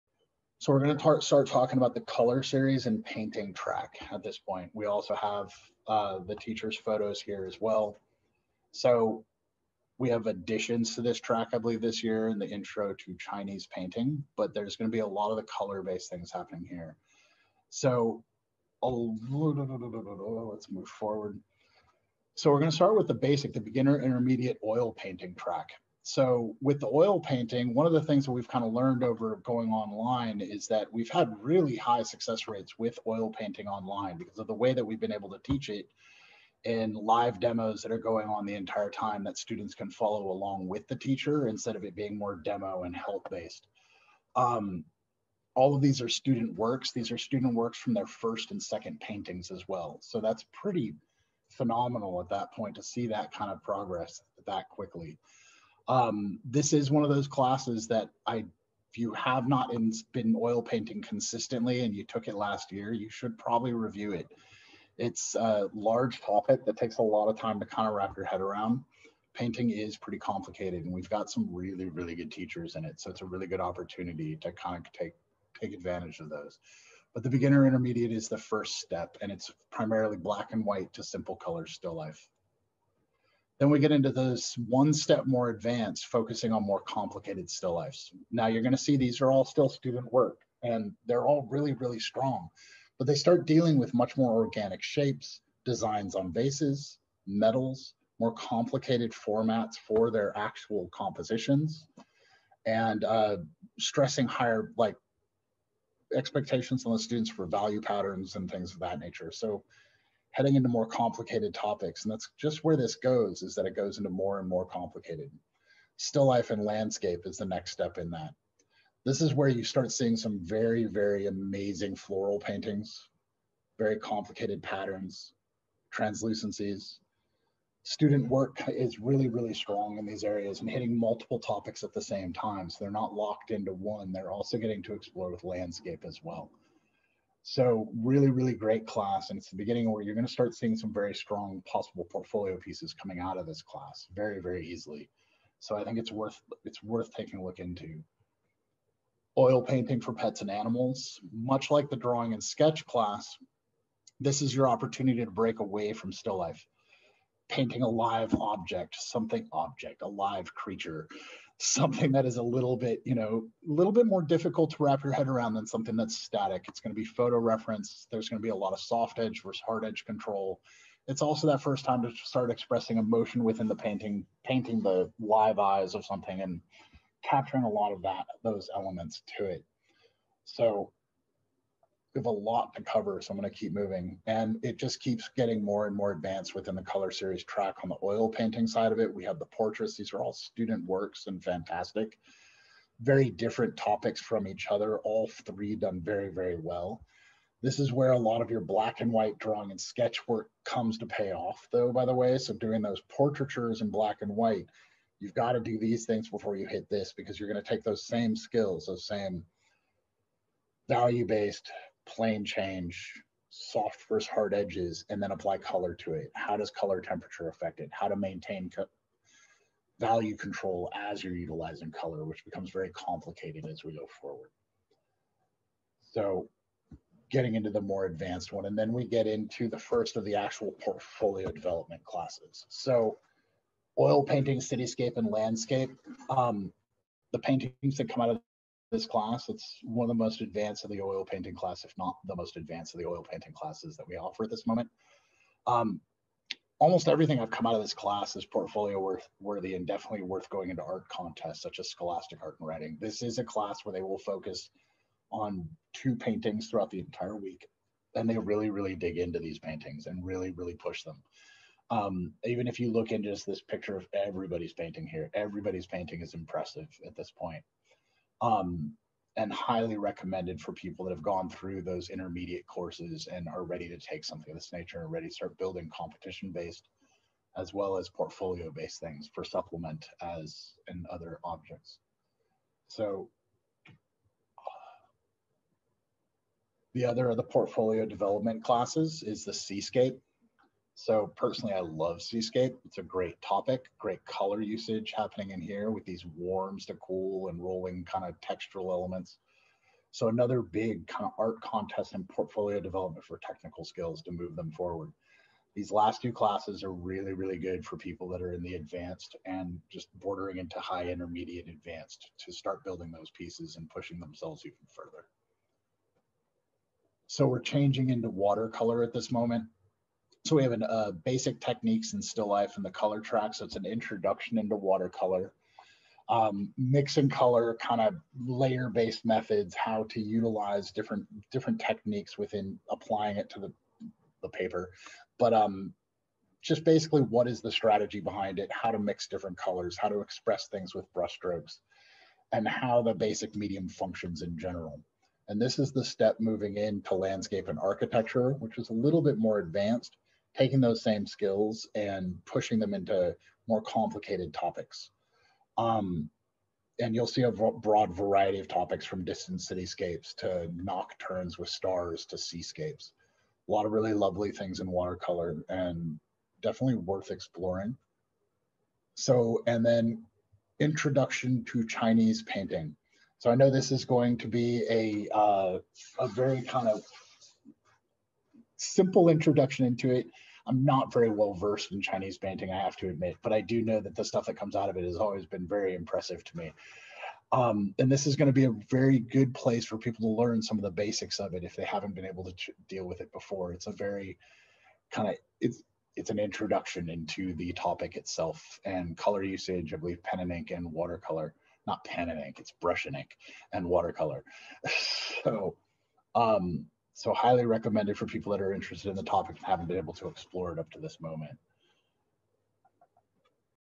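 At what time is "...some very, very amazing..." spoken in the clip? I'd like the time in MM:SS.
02:00.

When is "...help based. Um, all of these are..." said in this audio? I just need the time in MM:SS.
00:42.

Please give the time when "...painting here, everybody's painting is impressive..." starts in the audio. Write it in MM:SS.
04:24.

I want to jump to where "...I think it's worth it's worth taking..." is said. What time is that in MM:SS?
02:25.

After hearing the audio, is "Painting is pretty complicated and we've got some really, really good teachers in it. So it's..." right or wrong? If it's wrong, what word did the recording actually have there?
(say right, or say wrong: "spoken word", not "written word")
right.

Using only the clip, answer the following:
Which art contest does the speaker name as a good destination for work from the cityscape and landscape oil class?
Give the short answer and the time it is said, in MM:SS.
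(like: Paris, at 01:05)
Scholastic Art and Writing, at 04:11.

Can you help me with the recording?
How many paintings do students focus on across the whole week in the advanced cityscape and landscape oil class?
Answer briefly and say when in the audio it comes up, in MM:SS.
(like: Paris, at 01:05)
2, at 04:15.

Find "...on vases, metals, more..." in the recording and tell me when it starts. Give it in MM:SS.
01:36.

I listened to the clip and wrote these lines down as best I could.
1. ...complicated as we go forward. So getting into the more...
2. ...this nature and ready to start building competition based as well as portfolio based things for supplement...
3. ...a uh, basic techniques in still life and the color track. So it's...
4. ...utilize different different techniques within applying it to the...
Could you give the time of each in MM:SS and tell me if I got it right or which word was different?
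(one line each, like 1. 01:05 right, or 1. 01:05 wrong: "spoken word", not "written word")
1. 03:42 right
2. 04:34 right
3. 05:20 right
4. 05:30 right.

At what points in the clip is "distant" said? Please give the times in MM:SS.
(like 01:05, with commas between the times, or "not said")
05:59.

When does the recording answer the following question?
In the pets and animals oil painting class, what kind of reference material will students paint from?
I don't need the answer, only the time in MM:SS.
02:47.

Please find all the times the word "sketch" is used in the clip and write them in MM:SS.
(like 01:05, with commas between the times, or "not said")
02:32, 03:19.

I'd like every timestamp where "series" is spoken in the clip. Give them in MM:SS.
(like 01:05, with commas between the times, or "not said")
00:02, 03:07.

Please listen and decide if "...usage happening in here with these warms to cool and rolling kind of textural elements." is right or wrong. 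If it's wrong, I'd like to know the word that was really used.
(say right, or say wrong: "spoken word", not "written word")
right.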